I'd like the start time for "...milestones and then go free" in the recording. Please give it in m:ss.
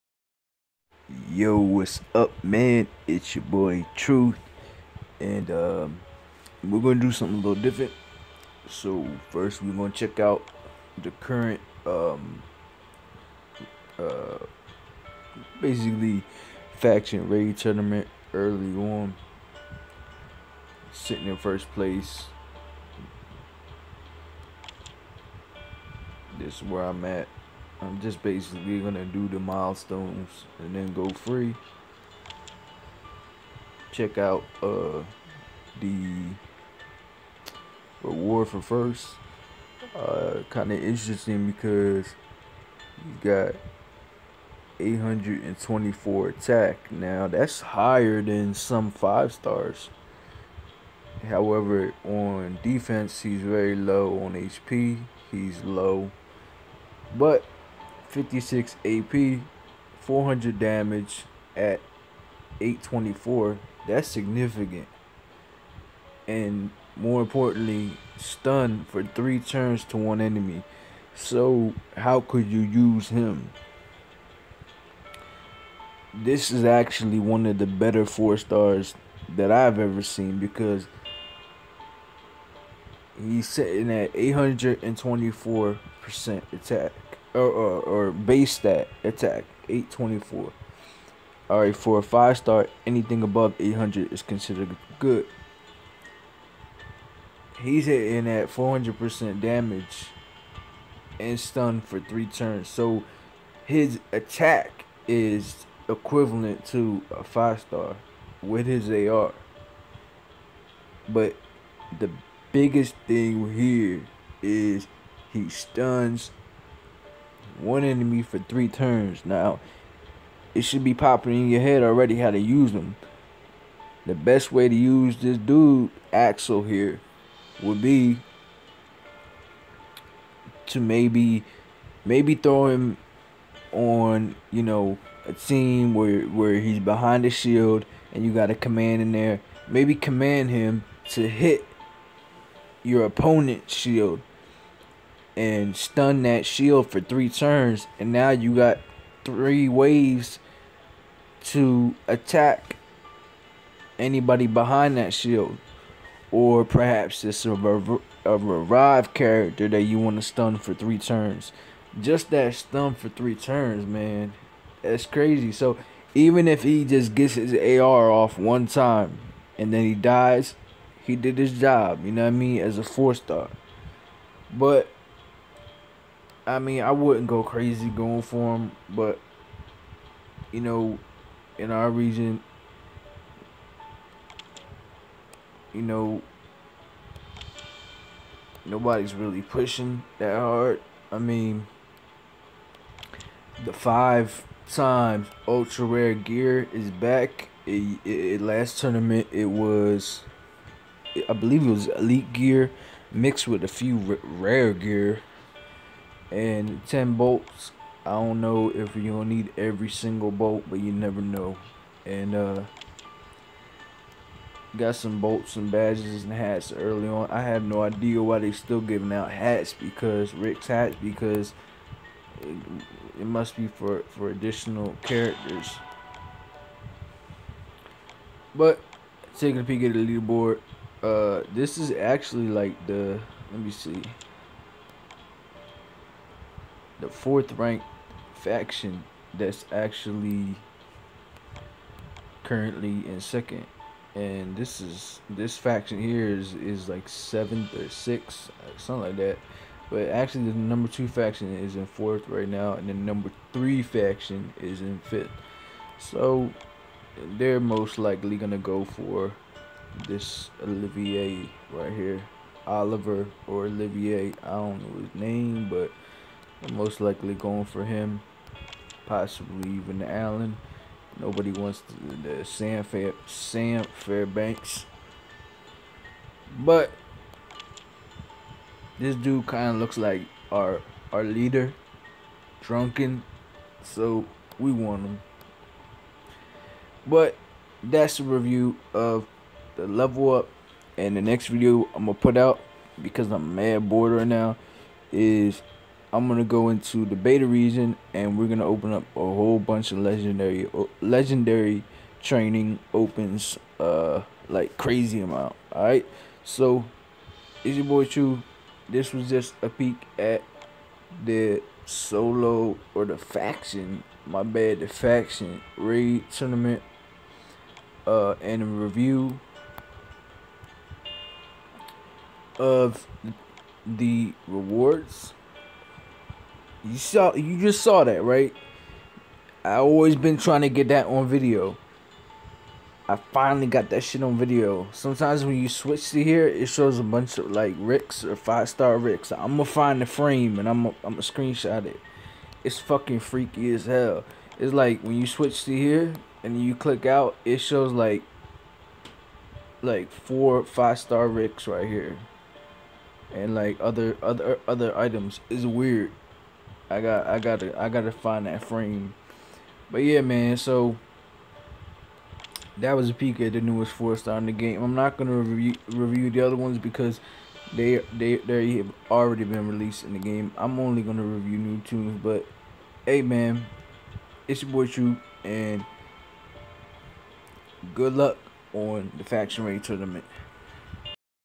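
0:29.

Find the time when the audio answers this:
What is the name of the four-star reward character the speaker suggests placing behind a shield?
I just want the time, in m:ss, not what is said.
2:06.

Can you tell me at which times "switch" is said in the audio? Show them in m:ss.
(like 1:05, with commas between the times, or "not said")
5:35, 5:45.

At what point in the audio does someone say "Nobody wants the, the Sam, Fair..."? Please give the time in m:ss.
4:31.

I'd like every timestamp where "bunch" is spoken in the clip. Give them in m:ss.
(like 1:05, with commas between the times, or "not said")
4:59, 5:37.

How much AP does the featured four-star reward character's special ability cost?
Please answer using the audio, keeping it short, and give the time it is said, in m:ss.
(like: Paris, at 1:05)
56, at 0:58.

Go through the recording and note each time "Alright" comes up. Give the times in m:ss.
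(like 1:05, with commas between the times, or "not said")
1:31, 5:05.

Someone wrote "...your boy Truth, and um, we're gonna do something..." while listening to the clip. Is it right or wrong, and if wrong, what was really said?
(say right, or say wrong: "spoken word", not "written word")
right.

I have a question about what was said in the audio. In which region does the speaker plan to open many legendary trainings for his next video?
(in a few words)
beta region.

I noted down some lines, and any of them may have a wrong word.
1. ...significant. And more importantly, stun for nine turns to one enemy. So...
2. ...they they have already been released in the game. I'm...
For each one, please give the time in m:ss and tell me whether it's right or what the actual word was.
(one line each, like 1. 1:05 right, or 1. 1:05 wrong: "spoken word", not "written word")
1. 1:04 wrong: "three", not "nine"
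2. 6:08 right.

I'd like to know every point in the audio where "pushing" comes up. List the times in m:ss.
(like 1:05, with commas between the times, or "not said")
3:09.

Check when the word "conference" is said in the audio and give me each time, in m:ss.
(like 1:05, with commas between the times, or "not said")
not said.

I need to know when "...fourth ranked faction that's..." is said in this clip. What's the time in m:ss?
3:57.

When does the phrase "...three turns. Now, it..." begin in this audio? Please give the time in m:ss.
1:58.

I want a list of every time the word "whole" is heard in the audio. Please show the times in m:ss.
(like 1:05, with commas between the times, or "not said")
4:59.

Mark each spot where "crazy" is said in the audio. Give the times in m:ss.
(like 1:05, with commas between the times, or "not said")
2:45, 2:57, 5:04.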